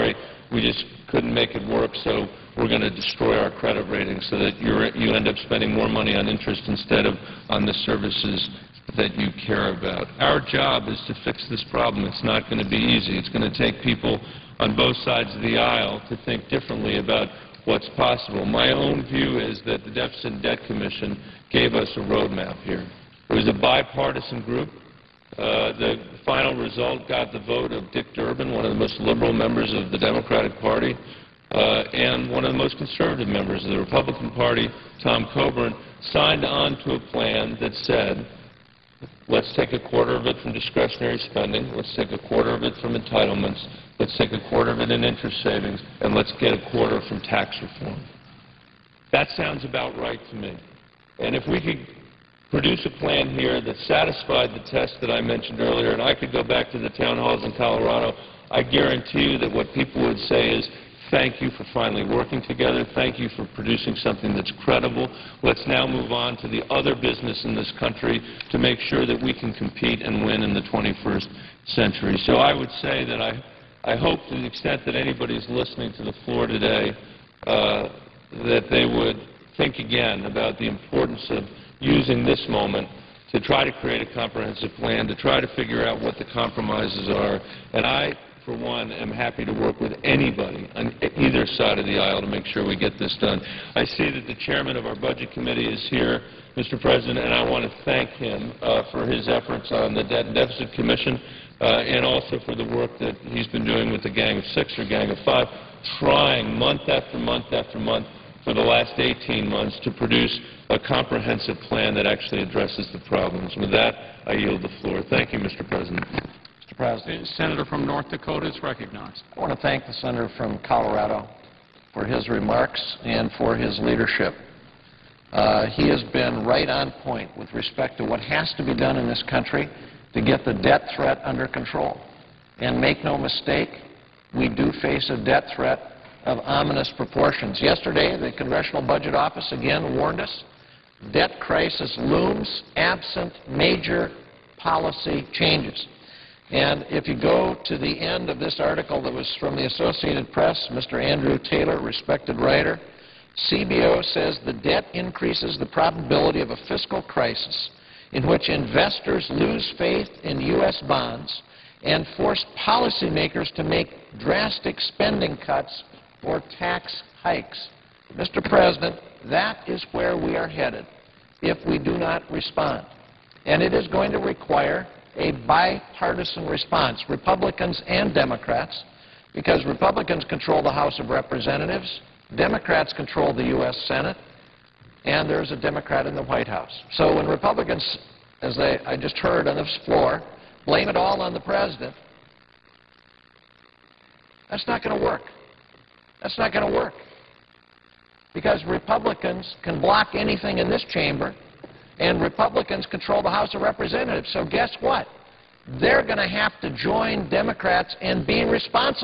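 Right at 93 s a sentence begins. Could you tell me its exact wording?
I see that the chairman of our budget committee is here, Mr.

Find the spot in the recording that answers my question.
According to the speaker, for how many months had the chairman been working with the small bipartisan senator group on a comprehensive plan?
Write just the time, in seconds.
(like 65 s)
108 s.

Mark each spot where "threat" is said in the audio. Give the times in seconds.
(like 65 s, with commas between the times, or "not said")
130 s, 135 s.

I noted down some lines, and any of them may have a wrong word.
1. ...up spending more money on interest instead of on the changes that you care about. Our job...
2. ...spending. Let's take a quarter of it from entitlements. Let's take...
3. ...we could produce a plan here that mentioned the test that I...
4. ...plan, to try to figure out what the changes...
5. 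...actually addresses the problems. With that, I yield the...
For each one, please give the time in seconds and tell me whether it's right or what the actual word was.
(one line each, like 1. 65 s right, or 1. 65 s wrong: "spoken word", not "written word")
1. 5 s wrong: "services", not "changes"
2. 41 s right
3. 51 s wrong: "satisfied", not "mentioned"
4. 84 s wrong: "compromises", not "changes"
5. 112 s right.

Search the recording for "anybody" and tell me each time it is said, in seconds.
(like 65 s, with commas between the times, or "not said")
74 s, 90 s.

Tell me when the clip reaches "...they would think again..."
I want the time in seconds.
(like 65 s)
78 s.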